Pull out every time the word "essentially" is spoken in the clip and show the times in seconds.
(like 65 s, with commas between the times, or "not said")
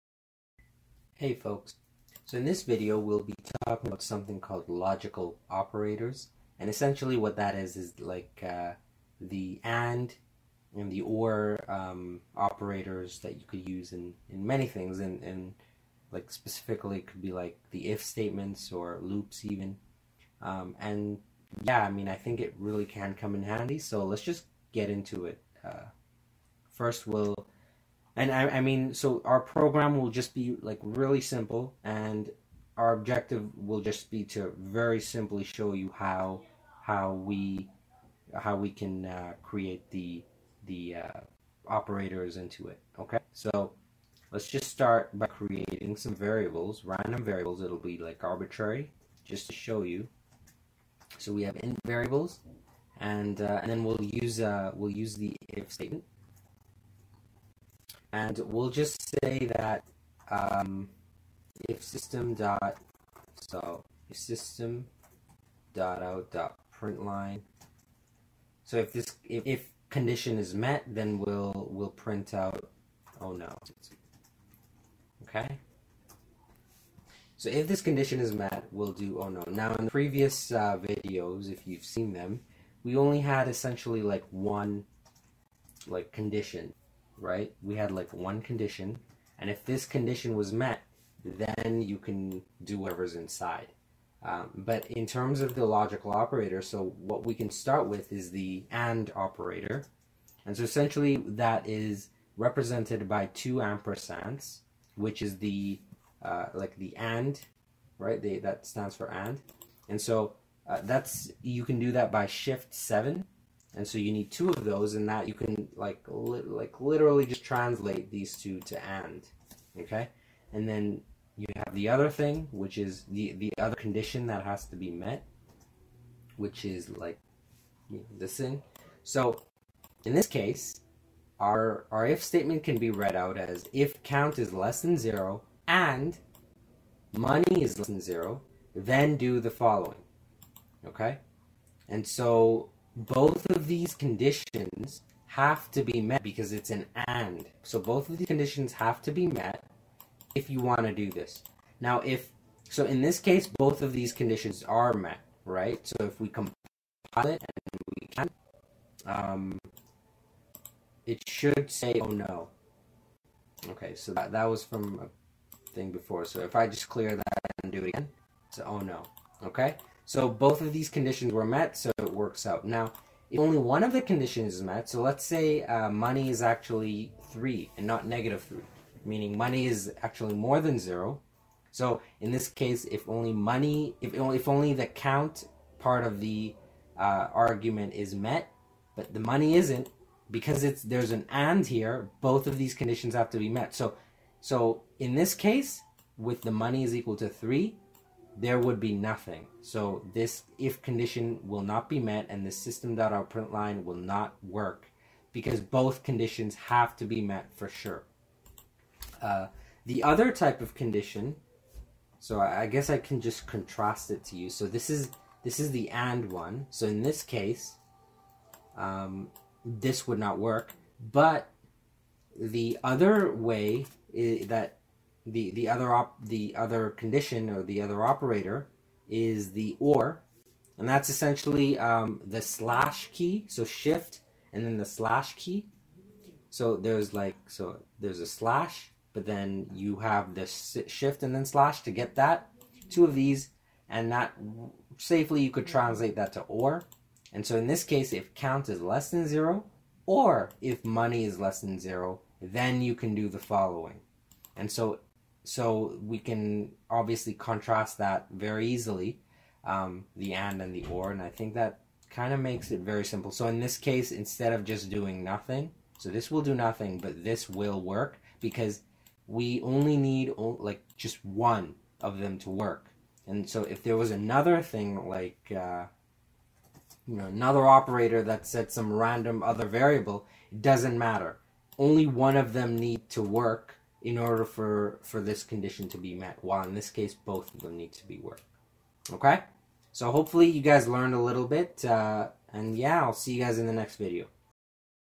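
6 s, 83 s, 100 s, 231 s.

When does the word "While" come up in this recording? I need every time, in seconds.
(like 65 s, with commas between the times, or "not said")
286 s.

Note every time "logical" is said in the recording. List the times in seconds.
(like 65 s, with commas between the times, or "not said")
4 s, 95 s.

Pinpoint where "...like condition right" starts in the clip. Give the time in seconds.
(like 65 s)
85 s.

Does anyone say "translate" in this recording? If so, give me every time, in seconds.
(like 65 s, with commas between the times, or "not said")
117 s, 245 s.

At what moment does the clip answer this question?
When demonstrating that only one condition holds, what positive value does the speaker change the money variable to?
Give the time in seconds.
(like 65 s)
175 s.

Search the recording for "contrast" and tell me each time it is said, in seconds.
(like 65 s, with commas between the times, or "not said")
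213 s, 257 s.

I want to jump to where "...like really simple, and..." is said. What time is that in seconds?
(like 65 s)
30 s.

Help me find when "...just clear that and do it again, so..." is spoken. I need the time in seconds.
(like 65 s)
166 s.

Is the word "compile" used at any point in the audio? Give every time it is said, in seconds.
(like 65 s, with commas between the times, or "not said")
156 s.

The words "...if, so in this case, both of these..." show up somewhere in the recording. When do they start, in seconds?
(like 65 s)
152 s.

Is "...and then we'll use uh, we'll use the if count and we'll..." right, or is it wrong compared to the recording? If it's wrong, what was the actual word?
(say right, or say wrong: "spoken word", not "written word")
wrong: "statement", not "count".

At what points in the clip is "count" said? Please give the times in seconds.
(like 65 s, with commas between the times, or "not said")
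134 s, 184 s, 248 s.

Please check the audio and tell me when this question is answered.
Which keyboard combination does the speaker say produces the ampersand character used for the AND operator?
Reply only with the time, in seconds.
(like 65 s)
112 s.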